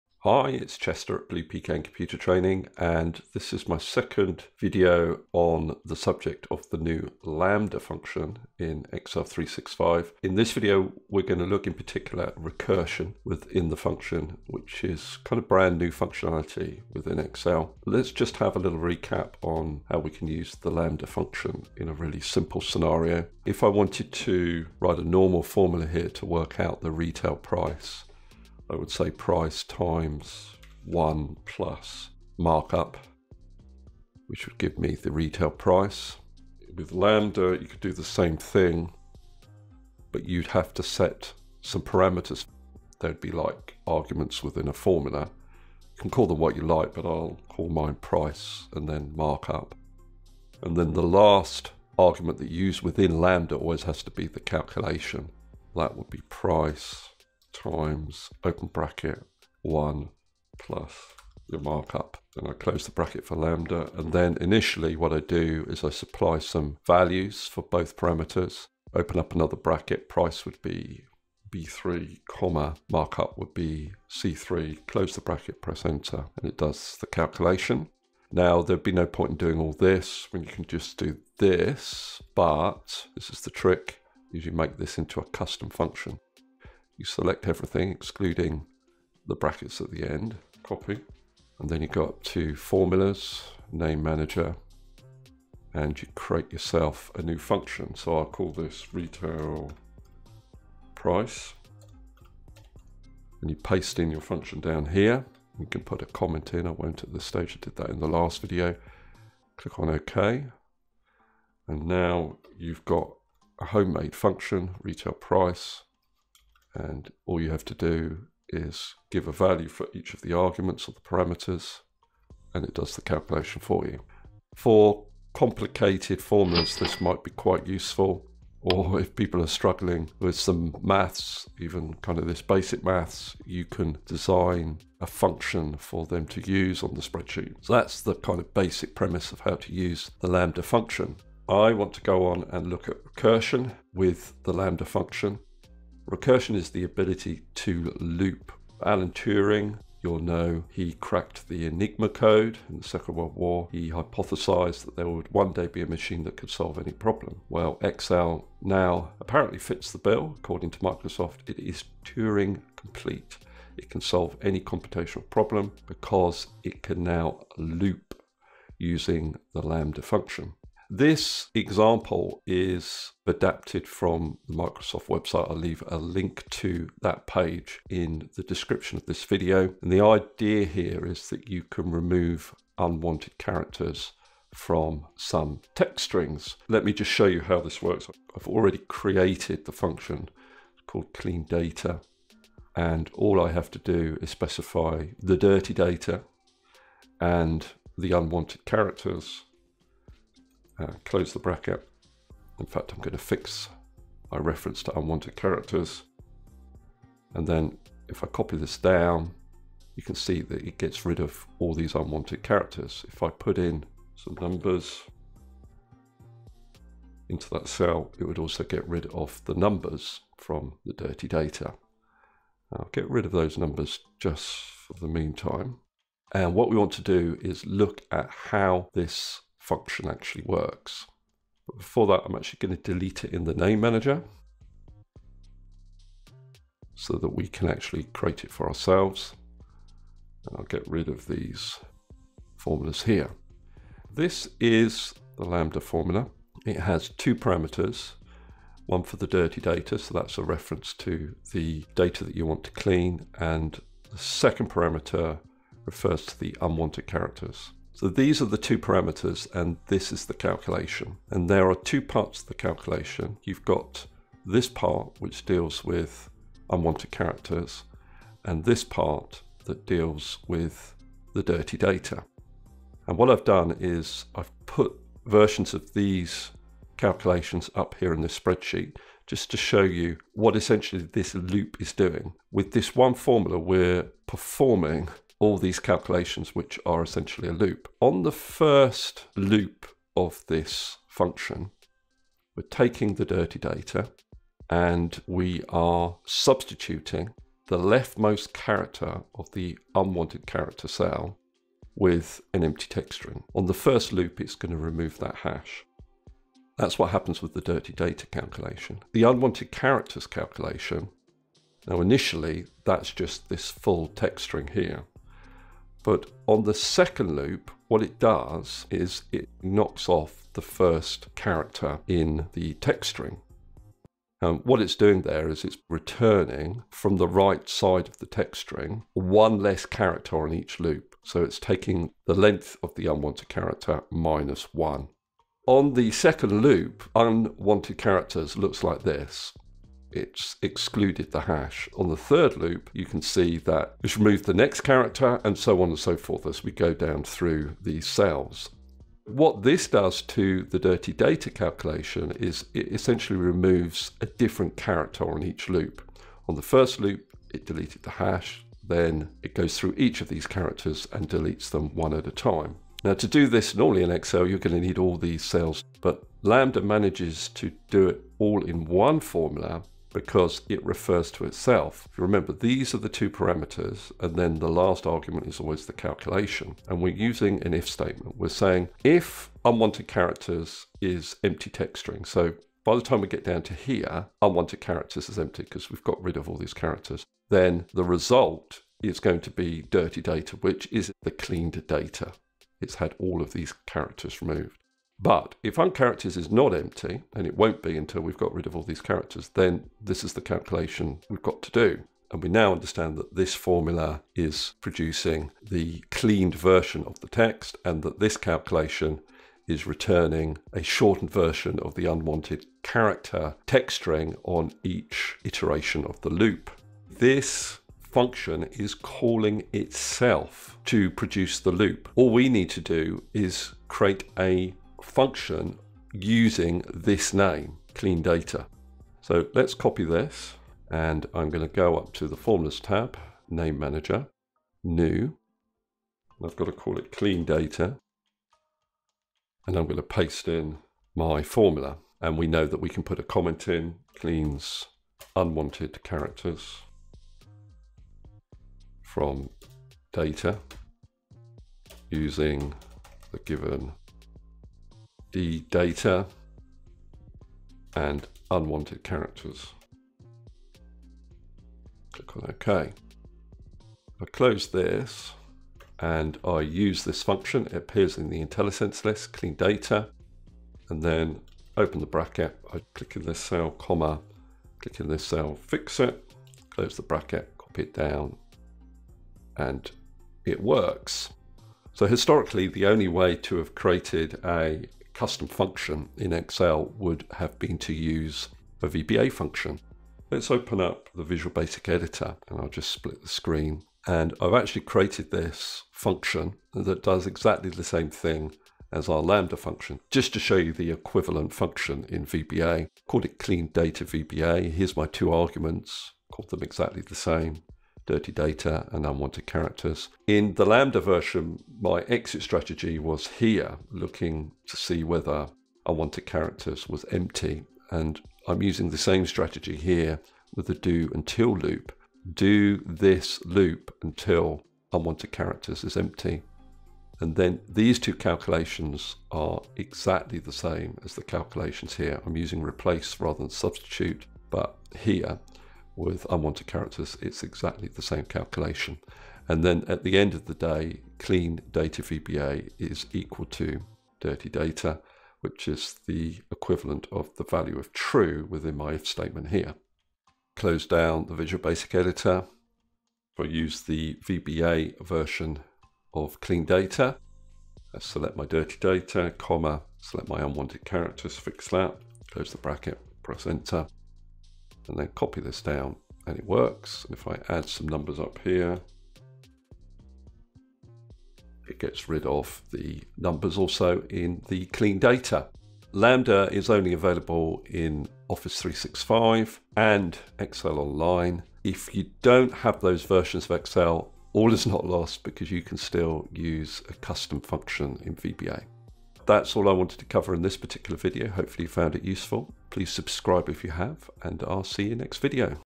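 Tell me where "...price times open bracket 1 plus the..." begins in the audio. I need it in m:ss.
0:56.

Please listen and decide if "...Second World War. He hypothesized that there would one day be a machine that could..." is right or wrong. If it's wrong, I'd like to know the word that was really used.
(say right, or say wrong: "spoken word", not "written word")
right.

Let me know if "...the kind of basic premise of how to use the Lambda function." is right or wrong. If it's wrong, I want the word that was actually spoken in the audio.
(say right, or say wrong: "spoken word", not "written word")
right.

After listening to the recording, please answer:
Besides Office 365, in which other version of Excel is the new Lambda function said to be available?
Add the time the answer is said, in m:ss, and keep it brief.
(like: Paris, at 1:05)
Excel Online, at 9:40.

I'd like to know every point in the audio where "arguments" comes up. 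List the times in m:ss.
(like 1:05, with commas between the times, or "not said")
0:43, 0:51, 2:00, 6:15, 8:25.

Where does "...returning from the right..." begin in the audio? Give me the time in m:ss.
5:25.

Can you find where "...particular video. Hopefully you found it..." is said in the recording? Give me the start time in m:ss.
9:50.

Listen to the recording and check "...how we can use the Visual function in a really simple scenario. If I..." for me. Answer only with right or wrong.
wrong.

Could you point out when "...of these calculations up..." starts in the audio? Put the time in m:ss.
4:35.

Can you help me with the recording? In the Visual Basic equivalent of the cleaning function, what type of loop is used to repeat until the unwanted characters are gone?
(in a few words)
Do Until loop.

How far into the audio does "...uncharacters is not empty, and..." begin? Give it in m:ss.
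6:35.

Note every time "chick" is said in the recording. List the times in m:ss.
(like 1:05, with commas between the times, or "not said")
not said.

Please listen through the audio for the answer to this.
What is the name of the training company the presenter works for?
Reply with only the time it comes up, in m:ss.
0:01.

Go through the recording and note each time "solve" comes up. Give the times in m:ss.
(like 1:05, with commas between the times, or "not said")
2:36, 2:44.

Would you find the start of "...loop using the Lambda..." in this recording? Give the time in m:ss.
2:47.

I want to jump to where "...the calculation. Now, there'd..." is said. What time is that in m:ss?
1:17.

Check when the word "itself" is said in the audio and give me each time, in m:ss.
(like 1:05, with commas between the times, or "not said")
6:11, 6:59.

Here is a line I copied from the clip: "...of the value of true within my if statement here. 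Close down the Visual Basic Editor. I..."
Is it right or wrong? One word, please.
right.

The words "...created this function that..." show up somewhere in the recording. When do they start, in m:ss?
8:14.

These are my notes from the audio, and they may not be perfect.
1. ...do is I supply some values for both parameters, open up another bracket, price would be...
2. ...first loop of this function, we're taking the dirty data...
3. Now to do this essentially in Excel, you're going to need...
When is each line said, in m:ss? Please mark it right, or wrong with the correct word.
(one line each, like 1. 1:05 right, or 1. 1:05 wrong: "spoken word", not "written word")
1. 1:05 right
2. 4:48 right
3. 6:03 wrong: "normally", not "essentially".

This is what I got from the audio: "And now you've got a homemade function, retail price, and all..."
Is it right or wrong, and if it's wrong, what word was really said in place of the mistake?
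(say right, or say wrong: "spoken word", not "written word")
right.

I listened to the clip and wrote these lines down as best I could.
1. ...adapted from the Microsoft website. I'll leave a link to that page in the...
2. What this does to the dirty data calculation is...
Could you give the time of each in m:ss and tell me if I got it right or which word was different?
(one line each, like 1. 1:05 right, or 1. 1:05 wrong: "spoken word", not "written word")
1. 2:53 right
2. 5:49 right.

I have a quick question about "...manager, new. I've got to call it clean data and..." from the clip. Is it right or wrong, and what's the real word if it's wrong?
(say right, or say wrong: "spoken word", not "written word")
right.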